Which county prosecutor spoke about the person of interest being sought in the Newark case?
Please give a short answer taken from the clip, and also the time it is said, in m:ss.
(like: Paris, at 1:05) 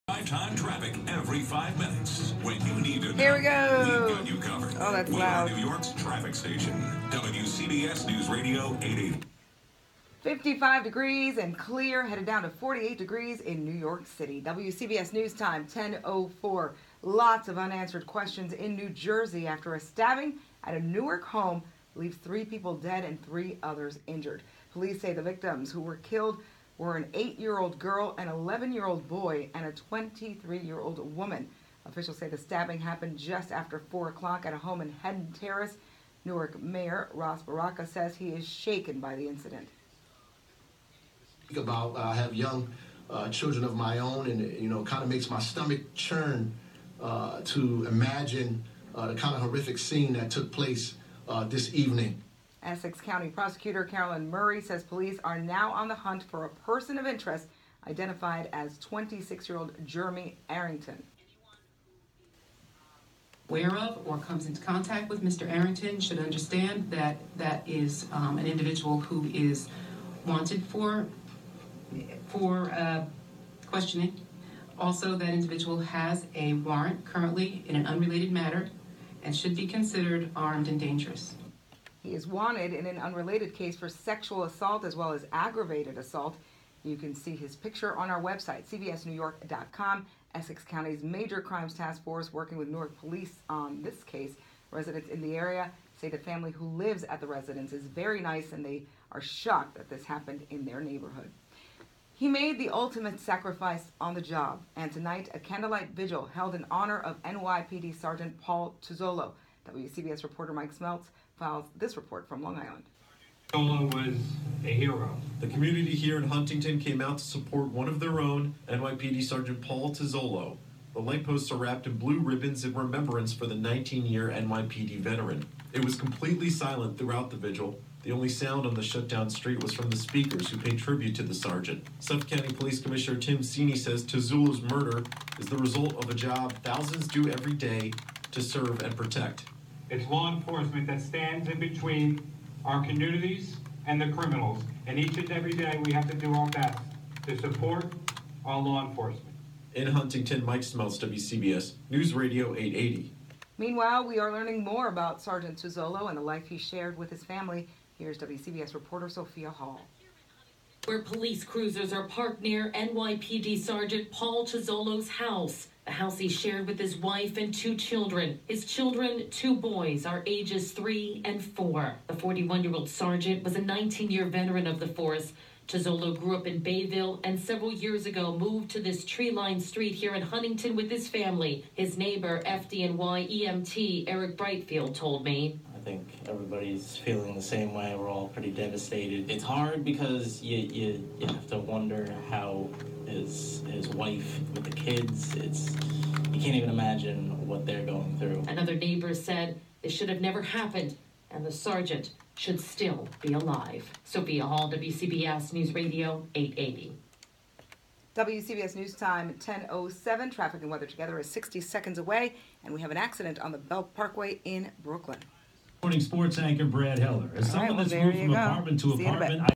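Carolyn Murray, at 0:53.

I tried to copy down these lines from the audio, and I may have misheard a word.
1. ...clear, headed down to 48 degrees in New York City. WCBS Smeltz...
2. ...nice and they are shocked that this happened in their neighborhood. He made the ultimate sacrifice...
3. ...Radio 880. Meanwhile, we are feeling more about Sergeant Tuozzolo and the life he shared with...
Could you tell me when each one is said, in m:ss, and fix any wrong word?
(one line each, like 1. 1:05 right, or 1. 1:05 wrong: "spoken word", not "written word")
1. 0:11 wrong: "News", not "Smeltz"
2. 1:38 right
3. 2:32 wrong: "learning", not "feeling".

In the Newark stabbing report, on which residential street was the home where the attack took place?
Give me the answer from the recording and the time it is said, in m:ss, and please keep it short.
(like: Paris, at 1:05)
Hedden Terrace, at 0:35.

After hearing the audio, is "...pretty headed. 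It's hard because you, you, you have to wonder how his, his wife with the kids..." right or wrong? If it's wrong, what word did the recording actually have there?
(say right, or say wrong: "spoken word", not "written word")
wrong: "devastated", not "headed".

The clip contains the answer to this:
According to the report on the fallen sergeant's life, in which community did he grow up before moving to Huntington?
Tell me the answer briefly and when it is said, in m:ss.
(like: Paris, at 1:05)
Bayville, at 2:56.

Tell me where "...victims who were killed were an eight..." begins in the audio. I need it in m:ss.
0:25.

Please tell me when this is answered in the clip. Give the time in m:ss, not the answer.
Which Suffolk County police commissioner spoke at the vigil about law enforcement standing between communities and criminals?
2:13.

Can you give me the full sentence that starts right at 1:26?
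You can see his picture on our website, cbsnewyork.com.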